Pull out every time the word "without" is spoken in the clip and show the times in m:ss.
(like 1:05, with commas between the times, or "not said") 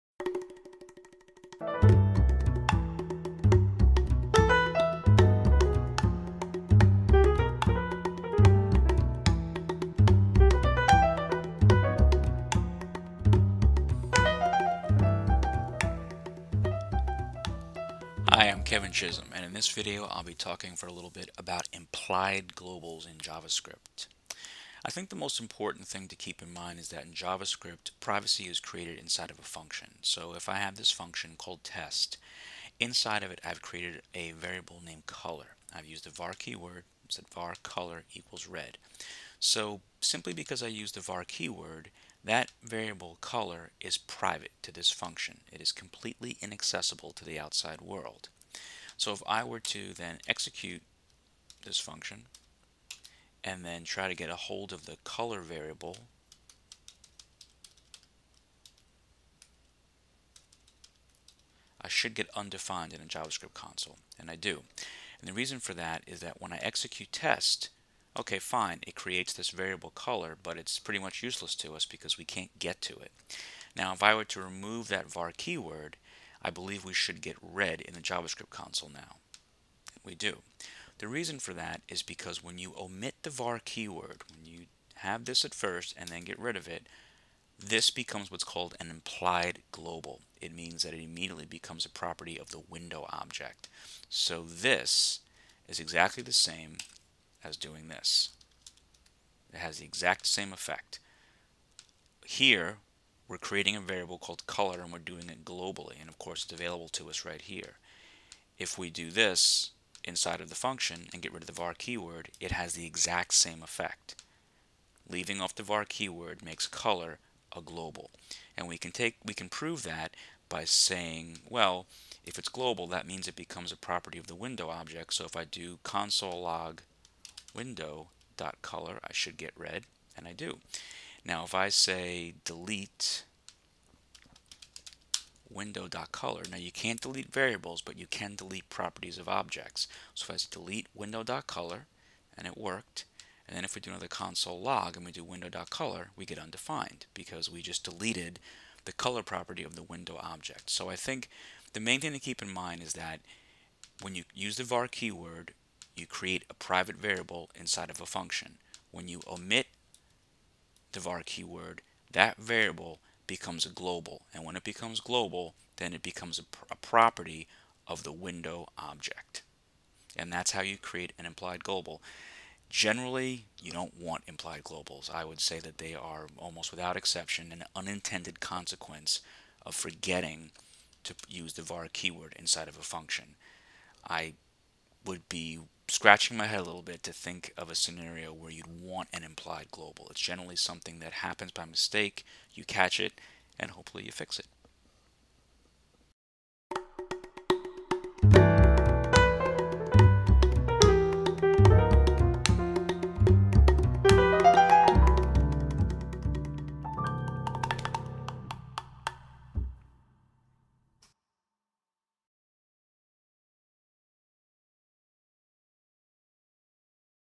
2:56.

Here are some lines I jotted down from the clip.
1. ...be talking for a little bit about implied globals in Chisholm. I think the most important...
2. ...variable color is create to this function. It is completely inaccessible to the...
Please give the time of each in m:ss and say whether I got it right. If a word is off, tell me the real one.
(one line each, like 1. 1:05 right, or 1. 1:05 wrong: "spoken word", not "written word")
1. 0:20 wrong: "JavaScript", not "Chisholm"
2. 0:42 wrong: "private", not "create".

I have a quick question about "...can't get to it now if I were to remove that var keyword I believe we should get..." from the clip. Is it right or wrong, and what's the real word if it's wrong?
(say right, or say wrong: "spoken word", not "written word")
right.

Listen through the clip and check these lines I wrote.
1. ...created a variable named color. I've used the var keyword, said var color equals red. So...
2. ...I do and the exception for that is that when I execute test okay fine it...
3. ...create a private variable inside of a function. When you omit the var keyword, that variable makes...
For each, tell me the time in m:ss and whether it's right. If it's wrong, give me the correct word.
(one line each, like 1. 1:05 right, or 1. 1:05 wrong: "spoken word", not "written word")
1. 0:33 right
2. 1:04 wrong: "reason", not "exception"
3. 2:36 wrong: "becomes", not "makes".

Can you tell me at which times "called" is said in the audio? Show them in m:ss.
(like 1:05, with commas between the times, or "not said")
0:31, 1:28, 1:44.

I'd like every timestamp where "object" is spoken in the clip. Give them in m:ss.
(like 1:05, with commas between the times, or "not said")
1:33, 2:04, 2:19, 2:30, 2:48.